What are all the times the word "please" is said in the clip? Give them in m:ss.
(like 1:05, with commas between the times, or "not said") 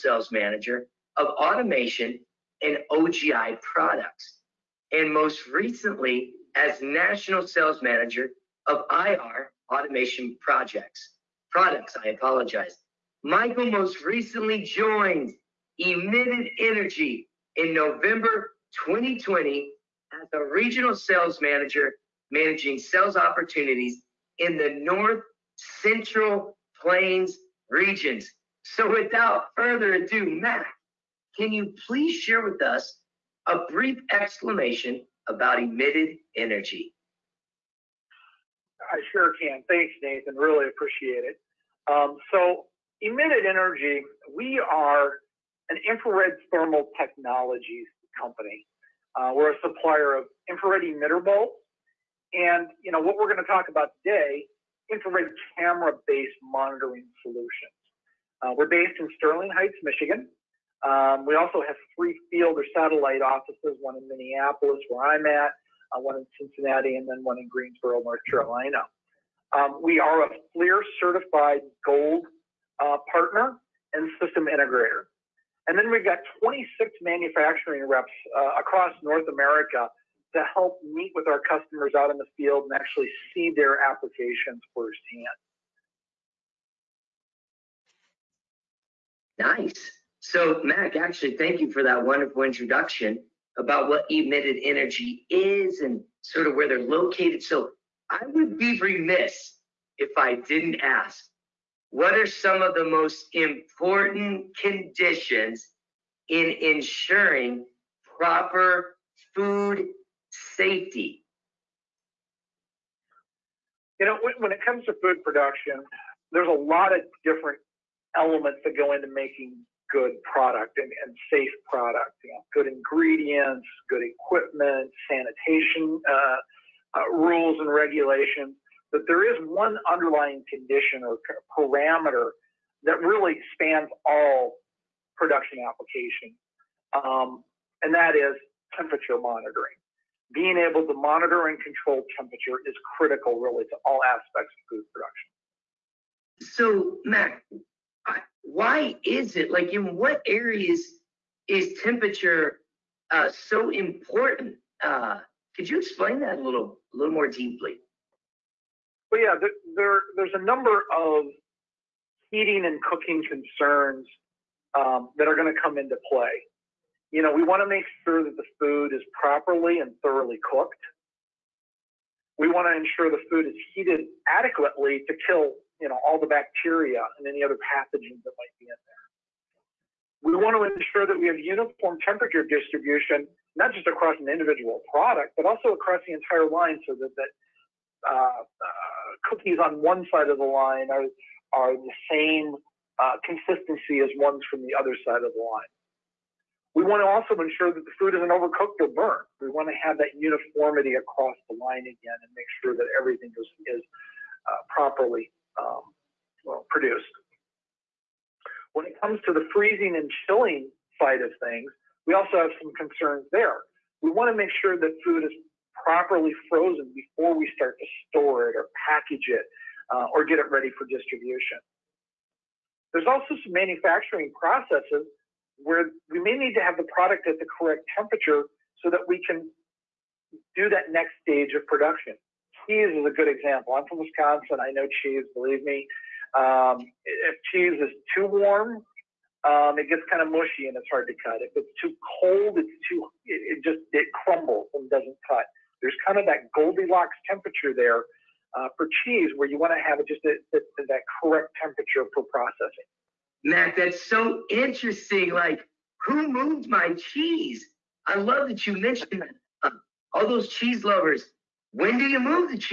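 0:31.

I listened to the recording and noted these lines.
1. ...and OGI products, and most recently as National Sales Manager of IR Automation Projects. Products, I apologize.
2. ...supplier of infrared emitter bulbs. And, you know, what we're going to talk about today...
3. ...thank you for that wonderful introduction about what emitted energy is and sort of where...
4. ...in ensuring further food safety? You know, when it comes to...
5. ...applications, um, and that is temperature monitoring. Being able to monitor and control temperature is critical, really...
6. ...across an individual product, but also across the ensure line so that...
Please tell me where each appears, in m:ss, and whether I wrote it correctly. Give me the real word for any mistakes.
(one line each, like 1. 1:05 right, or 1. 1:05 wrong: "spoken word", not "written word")
1. 0:02 right
2. 0:49 right
3. 1:31 right
4. 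1:46 wrong: "proper", not "further"
5. 2:15 right
6. 3:03 wrong: "entire", not "ensure".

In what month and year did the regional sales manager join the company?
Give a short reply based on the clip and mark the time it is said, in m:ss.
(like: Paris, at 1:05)
November 2020, at 0:17.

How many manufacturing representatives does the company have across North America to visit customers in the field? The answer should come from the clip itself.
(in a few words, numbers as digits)
26.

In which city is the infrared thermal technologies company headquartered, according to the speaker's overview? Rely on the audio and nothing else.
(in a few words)
Sterling Heights, Michigan.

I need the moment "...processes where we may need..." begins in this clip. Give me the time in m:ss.
3:44.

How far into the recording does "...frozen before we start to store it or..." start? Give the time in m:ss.
3:36.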